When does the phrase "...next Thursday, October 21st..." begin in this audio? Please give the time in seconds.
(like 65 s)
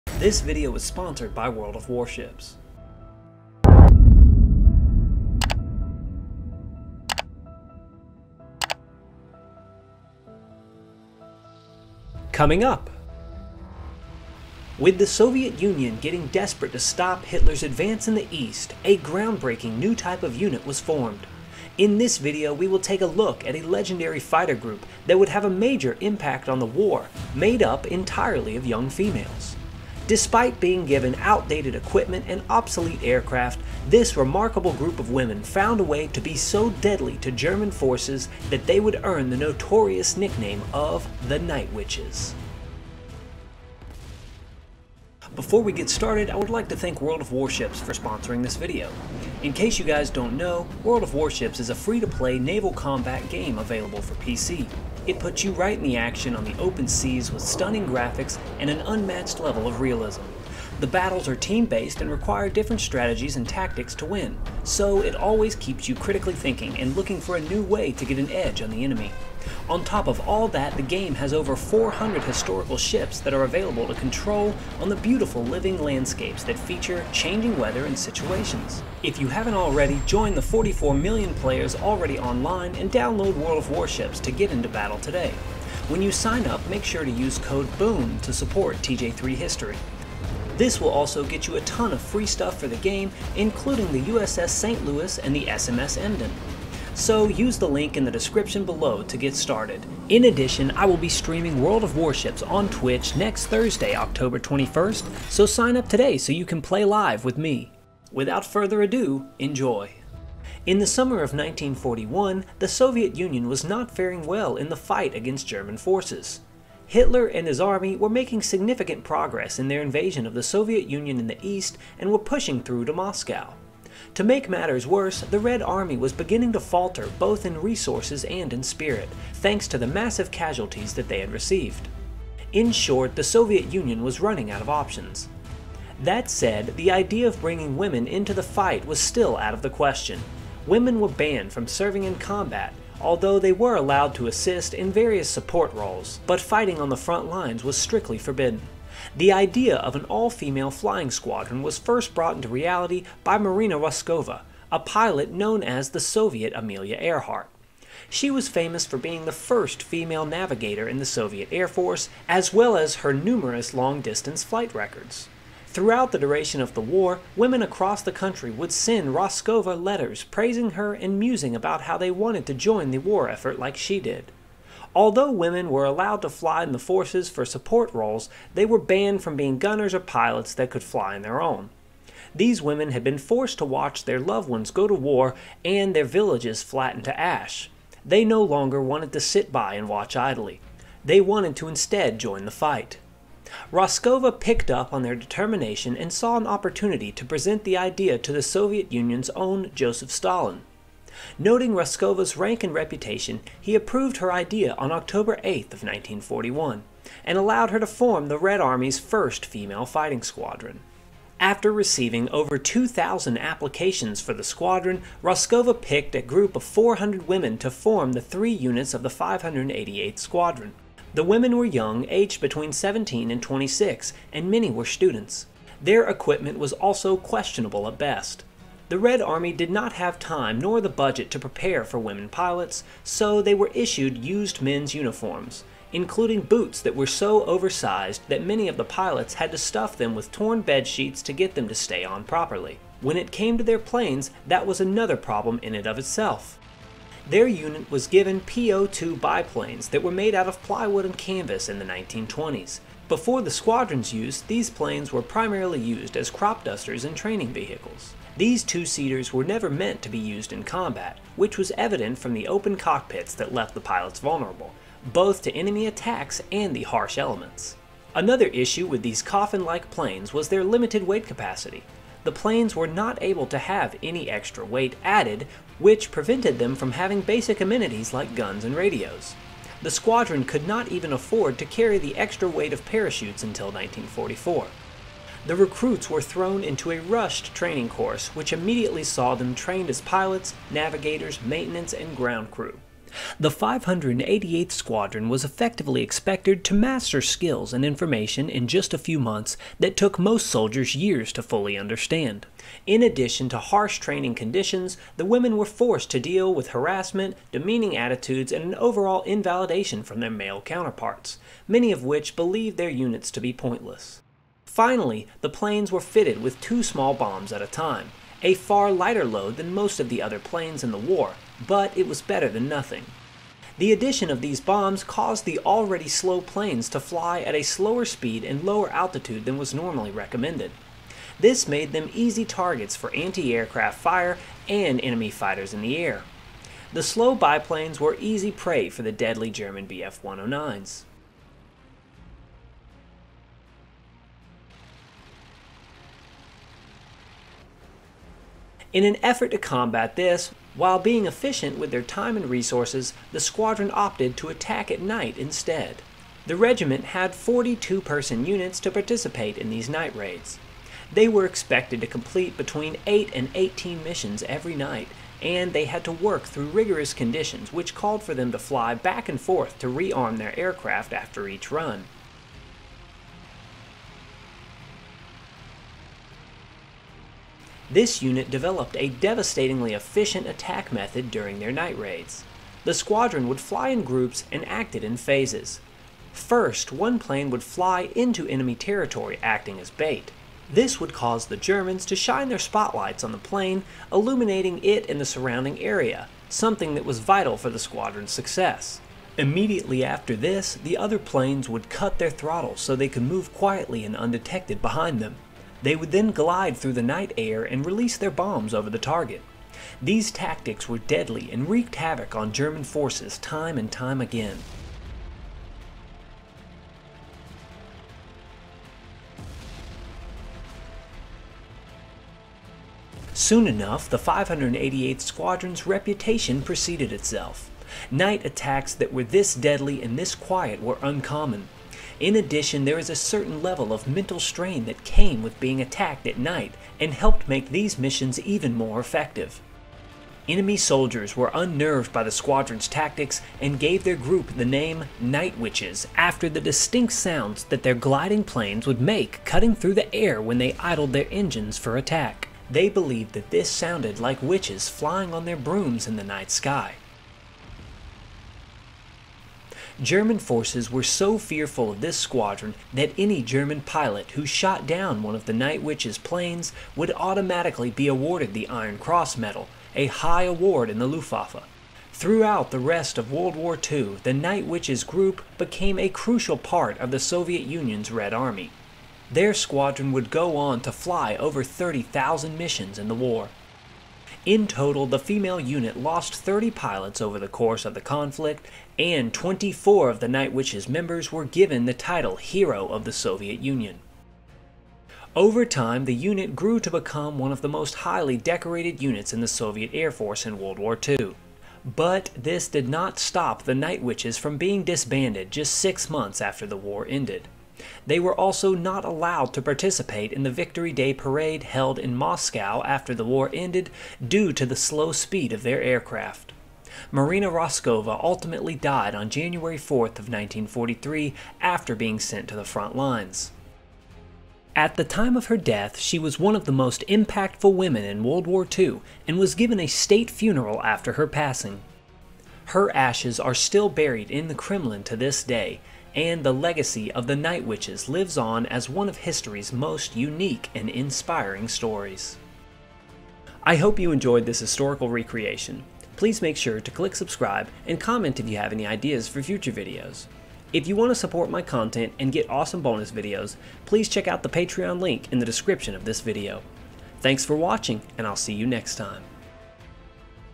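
103 s.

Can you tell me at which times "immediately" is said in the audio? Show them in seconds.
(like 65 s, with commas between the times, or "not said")
288 s, 399 s.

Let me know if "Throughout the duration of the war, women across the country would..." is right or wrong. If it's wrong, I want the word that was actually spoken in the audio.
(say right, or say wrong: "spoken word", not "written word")
right.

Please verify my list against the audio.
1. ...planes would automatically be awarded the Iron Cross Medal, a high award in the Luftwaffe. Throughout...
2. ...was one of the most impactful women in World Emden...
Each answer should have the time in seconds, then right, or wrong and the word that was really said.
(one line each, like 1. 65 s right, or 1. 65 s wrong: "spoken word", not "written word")
1. 466 s right
2. 526 s wrong: "War", not "Emden".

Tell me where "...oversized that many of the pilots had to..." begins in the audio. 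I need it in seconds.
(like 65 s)
237 s.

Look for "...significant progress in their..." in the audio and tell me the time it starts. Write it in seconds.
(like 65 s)
118 s.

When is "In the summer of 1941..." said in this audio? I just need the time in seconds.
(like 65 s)
110 s.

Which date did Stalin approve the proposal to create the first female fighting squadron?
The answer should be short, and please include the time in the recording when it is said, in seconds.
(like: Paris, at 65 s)
October 8th of 1941, at 204 s.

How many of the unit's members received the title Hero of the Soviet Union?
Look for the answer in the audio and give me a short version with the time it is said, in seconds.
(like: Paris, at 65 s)
24, at 489 s.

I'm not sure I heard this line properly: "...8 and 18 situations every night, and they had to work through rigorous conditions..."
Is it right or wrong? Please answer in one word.
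wrong.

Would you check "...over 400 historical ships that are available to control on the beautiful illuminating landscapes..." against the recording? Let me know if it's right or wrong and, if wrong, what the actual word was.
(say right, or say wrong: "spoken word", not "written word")
wrong: "living", not "illuminating".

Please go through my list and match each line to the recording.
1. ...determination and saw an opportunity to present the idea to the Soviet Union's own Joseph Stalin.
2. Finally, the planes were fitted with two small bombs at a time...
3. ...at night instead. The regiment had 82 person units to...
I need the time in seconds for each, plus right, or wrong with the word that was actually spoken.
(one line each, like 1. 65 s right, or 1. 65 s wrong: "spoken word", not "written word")
1. 195 s right
2. 314 s right
3. 354 s wrong: "42", not "82".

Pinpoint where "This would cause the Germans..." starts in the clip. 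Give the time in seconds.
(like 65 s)
390 s.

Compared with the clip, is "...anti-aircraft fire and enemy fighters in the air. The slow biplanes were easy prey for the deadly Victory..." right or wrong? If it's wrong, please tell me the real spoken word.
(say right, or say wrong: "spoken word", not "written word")
wrong: "German", not "Victory".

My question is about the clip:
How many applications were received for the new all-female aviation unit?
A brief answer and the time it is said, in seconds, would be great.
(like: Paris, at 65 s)
over 2,000, at 212 s.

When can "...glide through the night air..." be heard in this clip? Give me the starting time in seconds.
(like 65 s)
406 s.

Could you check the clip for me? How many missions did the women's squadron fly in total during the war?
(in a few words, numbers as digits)
over 30,000.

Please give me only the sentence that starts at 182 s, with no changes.
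These women had been forced to watch their loved ones go to war and their villages flatten to ash.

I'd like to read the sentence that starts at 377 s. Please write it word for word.
This unit developed a devastatingly efficient attack method during their night raids.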